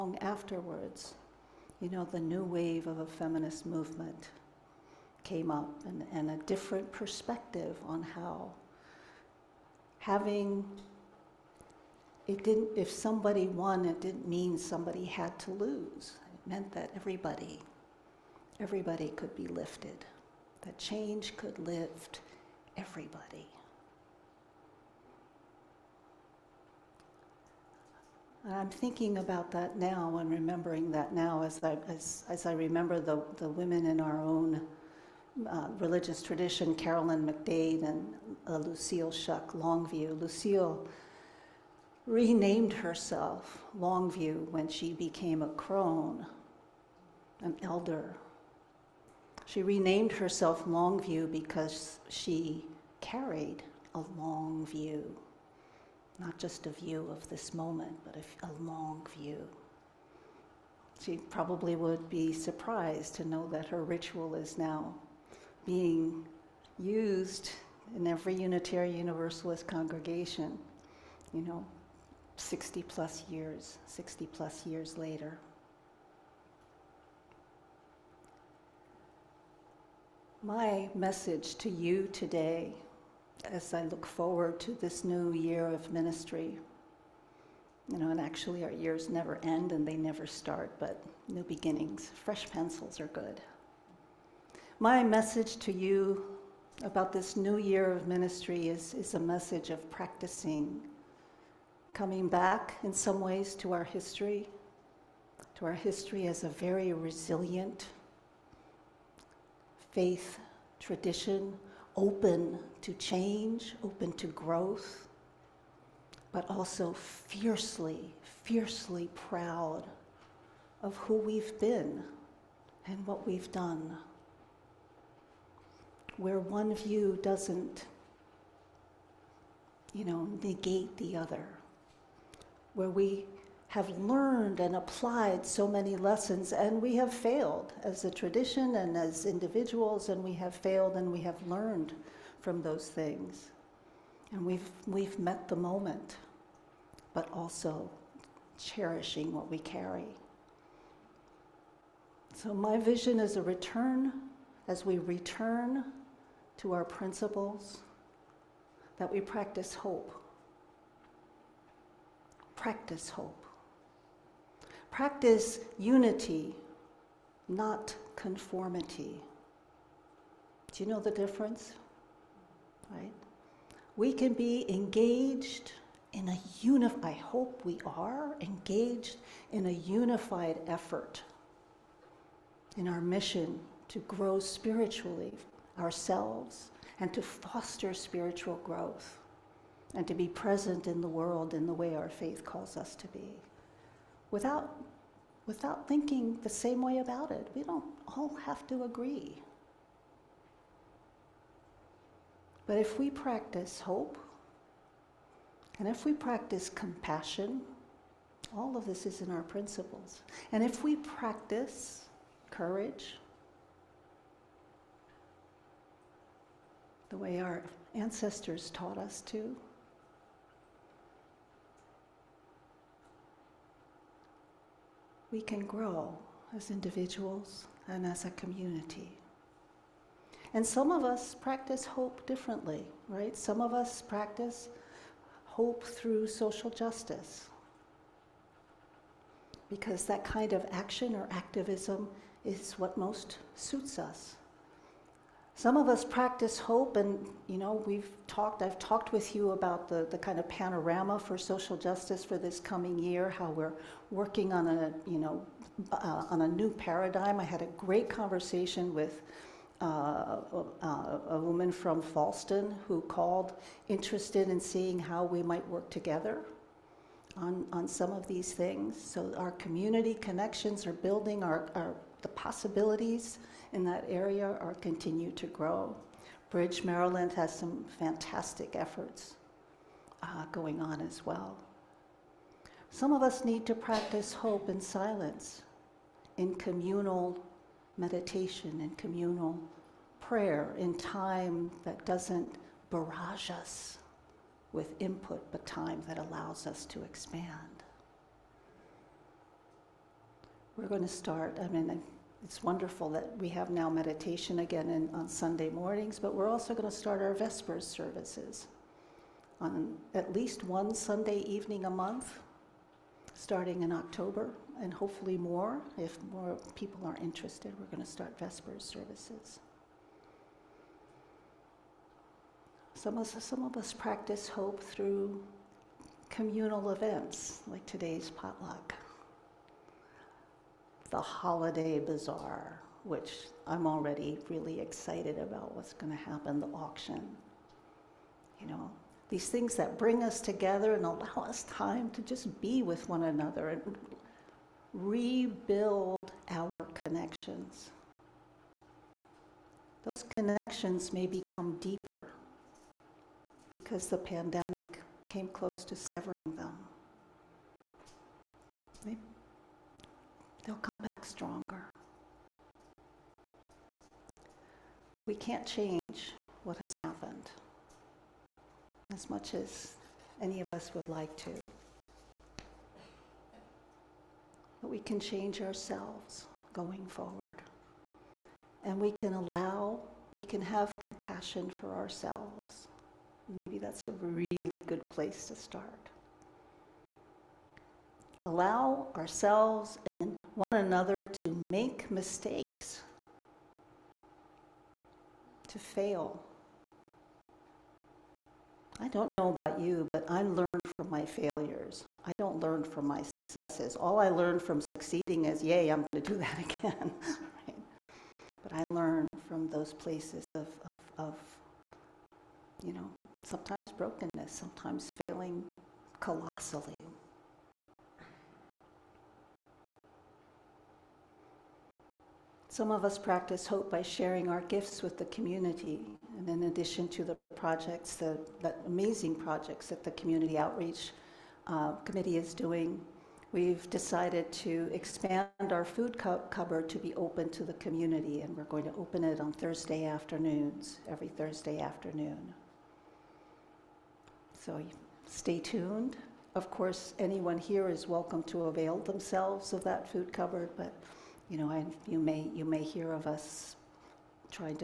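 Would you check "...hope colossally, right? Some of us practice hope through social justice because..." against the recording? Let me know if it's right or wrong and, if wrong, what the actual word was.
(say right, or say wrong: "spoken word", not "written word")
wrong: "differently", not "colossally".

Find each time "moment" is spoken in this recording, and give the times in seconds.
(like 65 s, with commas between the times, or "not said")
57 s, 145 s.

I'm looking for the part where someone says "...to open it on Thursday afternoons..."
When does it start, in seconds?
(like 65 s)
438 s.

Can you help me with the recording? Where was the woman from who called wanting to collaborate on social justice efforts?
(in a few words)
Falston.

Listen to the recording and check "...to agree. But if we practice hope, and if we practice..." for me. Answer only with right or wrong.
right.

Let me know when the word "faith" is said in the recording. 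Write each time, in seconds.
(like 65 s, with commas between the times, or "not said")
109 s, 192 s.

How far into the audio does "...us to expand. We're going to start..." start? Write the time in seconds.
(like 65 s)
296 s.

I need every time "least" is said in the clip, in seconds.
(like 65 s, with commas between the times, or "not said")
310 s.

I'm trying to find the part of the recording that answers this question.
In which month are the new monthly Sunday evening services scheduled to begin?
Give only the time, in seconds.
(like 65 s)
313 s.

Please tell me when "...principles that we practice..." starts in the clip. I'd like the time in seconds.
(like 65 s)
156 s.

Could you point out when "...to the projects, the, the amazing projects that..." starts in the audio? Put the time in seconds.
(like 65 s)
427 s.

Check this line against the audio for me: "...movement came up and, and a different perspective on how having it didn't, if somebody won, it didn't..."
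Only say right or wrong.
right.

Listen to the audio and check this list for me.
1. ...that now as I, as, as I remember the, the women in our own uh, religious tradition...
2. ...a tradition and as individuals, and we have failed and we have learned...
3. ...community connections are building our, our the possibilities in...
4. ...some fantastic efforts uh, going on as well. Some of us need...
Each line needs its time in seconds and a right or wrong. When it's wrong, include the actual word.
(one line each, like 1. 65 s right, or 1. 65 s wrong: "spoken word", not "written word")
1. 30 s right
2. 138 s right
3. 269 s right
4. 277 s right.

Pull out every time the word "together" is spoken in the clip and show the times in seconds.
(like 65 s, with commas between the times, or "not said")
265 s, 340 s.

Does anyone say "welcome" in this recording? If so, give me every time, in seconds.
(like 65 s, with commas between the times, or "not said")
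448 s.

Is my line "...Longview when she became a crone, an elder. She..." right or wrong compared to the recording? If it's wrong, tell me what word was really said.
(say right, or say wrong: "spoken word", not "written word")
right.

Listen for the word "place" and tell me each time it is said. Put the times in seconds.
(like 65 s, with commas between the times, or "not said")
385 s, 409 s.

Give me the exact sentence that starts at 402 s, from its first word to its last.
I don't learn from my successes.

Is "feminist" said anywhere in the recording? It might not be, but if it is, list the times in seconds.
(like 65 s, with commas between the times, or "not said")
3 s.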